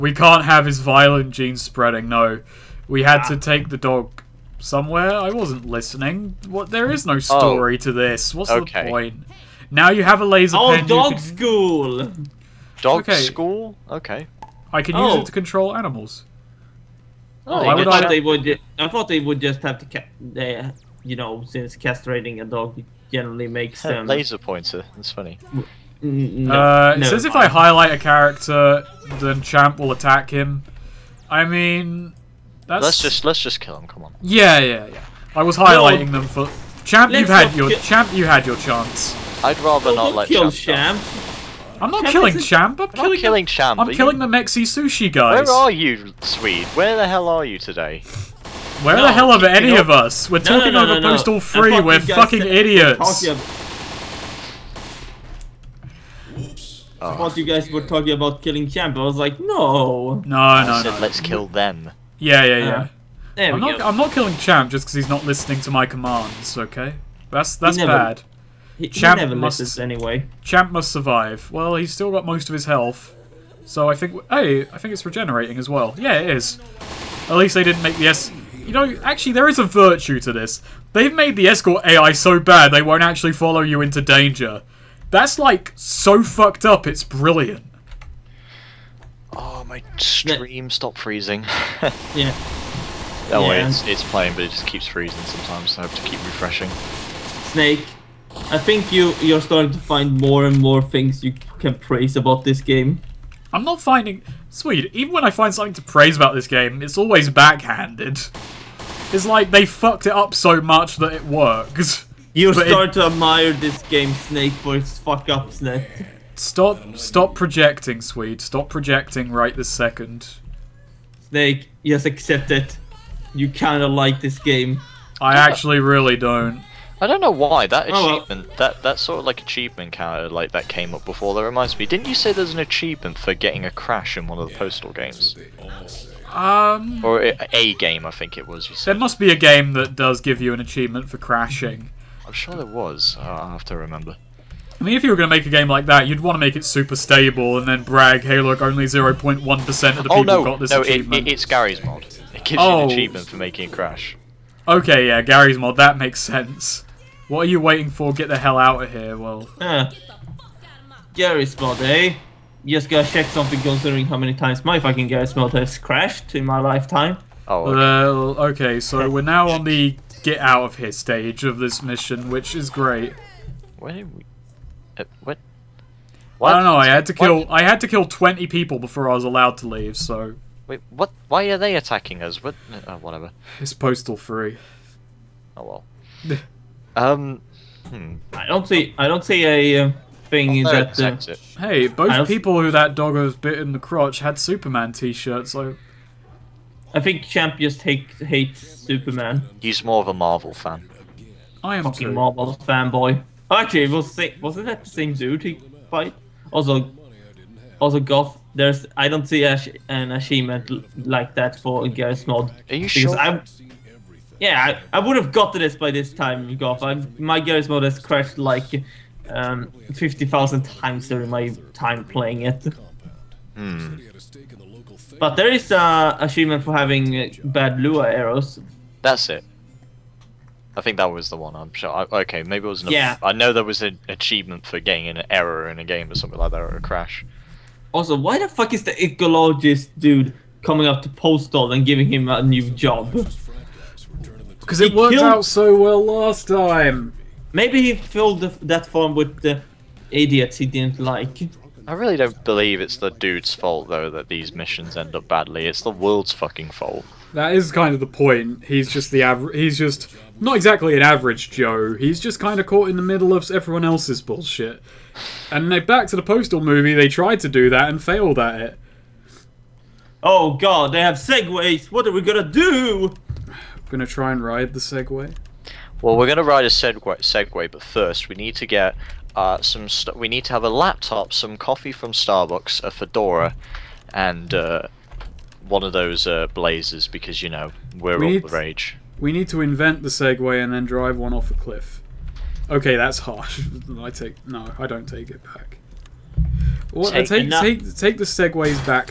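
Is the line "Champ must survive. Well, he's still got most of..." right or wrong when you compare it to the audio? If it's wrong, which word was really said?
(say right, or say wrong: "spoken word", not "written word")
right.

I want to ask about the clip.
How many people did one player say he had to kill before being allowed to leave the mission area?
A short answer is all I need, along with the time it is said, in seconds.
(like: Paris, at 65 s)
20, at 178 s.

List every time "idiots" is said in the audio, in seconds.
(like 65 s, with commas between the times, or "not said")
52 s, 250 s.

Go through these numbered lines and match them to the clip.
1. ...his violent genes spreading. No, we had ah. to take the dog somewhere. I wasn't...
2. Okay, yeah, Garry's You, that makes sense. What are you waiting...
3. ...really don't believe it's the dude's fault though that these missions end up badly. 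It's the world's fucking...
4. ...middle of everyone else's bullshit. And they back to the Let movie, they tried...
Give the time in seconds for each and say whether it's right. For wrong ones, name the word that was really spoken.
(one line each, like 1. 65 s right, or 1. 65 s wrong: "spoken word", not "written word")
1. 0 s right
2. 154 s wrong: "Mod", not "You"
3. 251 s right
4. 263 s wrong: "Postal", not "Let".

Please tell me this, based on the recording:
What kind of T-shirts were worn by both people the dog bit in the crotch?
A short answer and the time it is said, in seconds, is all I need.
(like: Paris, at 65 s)
Superman T-shirts, at 194 s.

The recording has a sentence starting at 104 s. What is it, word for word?
Sweet, even when I find something to praise about this game, it's always backhanded.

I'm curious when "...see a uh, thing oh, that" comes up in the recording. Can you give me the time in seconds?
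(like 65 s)
189 s.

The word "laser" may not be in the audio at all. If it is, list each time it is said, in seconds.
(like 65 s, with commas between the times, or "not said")
10 s, 24 s.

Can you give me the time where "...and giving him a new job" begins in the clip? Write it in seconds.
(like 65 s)
241 s.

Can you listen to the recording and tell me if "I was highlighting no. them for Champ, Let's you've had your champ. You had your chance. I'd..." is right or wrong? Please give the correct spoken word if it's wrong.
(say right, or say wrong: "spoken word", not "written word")
right.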